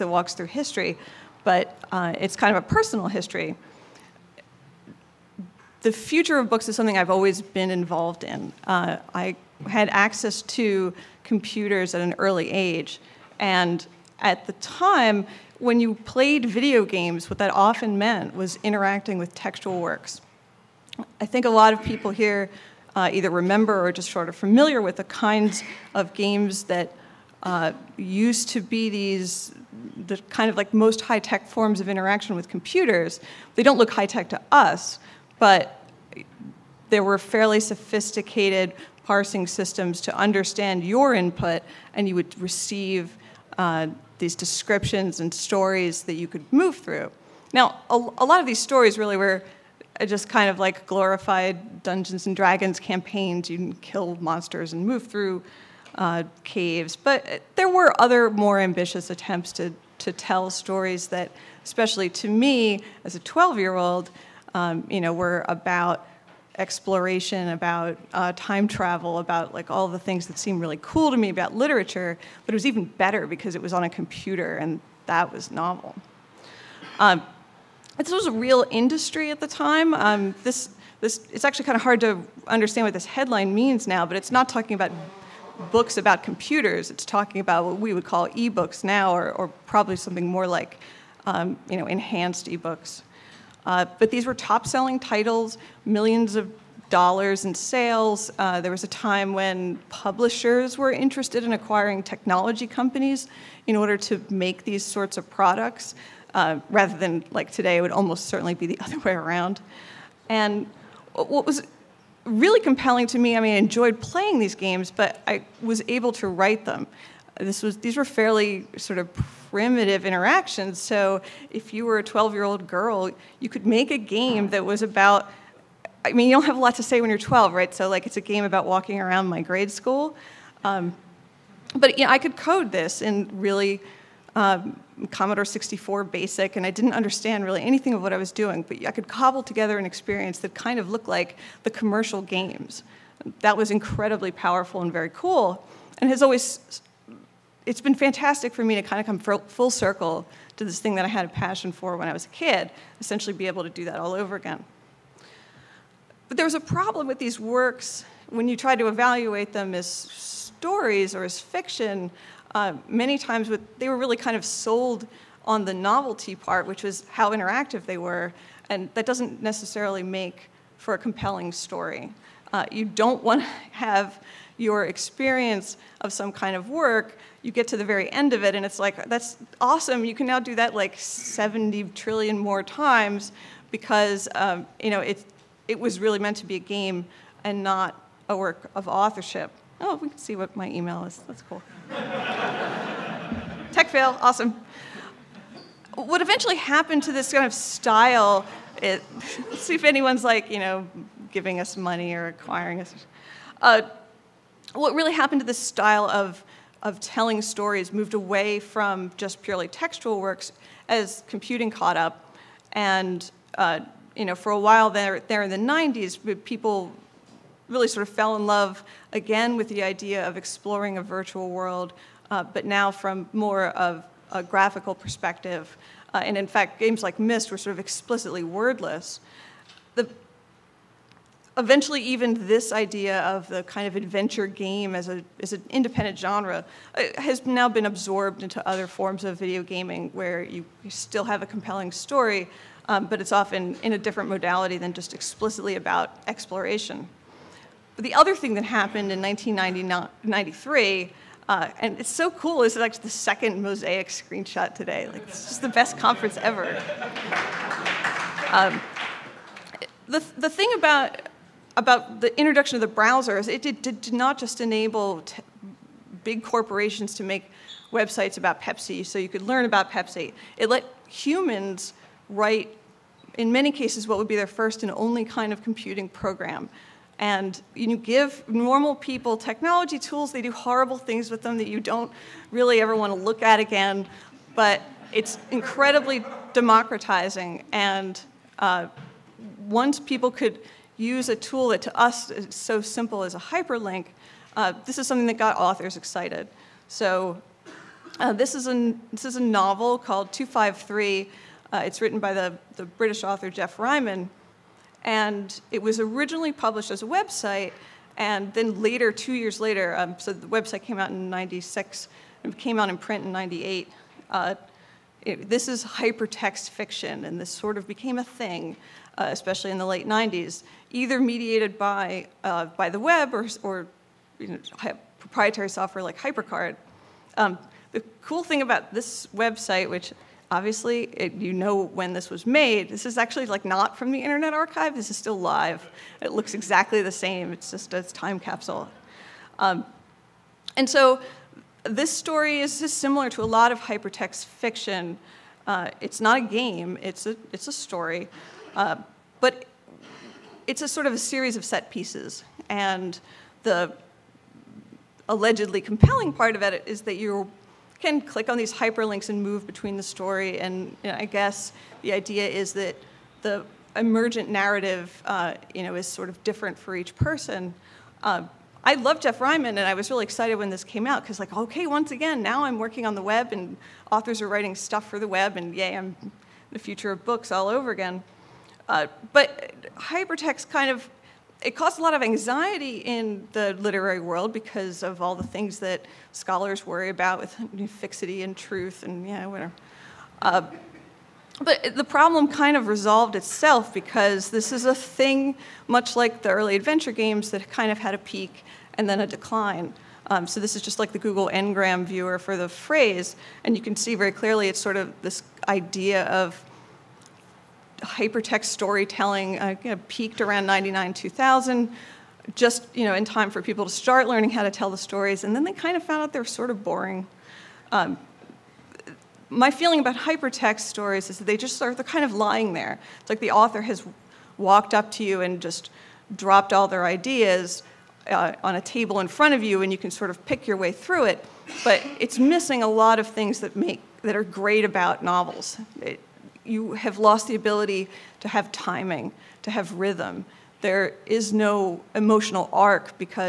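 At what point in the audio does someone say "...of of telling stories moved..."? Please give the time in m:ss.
3:26.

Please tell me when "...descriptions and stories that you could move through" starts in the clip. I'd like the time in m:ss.
0:44.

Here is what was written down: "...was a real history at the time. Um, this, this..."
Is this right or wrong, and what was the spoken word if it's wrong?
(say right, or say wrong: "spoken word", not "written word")
wrong: "industry", not "history".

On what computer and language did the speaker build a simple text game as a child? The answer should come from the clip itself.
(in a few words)
Commodore 64 basic.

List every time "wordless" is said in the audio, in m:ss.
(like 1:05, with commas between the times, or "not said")
3:48.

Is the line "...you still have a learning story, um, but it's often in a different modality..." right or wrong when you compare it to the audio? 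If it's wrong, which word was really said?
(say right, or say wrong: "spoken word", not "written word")
wrong: "compelling", not "learning".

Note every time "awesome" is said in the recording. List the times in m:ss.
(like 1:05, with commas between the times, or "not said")
2:59, 3:14.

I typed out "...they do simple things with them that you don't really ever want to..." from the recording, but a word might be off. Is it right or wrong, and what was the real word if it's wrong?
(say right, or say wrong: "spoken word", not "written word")
wrong: "horrible", not "simple".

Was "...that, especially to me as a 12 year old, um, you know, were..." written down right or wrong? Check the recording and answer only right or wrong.
right.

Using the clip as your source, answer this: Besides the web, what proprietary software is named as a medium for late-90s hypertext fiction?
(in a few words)
HyperCard.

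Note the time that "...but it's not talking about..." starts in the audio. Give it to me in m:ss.
1:24.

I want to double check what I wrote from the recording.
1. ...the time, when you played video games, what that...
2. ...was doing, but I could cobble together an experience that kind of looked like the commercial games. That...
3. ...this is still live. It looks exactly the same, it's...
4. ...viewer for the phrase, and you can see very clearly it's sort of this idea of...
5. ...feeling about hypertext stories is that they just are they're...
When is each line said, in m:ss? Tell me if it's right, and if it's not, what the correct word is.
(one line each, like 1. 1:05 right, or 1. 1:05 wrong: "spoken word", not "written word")
1. 0:14 right
2. 2:18 right
3. 5:34 right
4. 6:42 right
5. 6:59 right.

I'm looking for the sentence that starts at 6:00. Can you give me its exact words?
And you know, I guess the idea is that the emergent narrative, uh, you know, is sort of different for each person.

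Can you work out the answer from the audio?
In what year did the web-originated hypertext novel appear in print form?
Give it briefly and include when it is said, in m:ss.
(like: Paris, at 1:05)
1998, at 5:13.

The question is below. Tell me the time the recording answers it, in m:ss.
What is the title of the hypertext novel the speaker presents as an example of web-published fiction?
5:00.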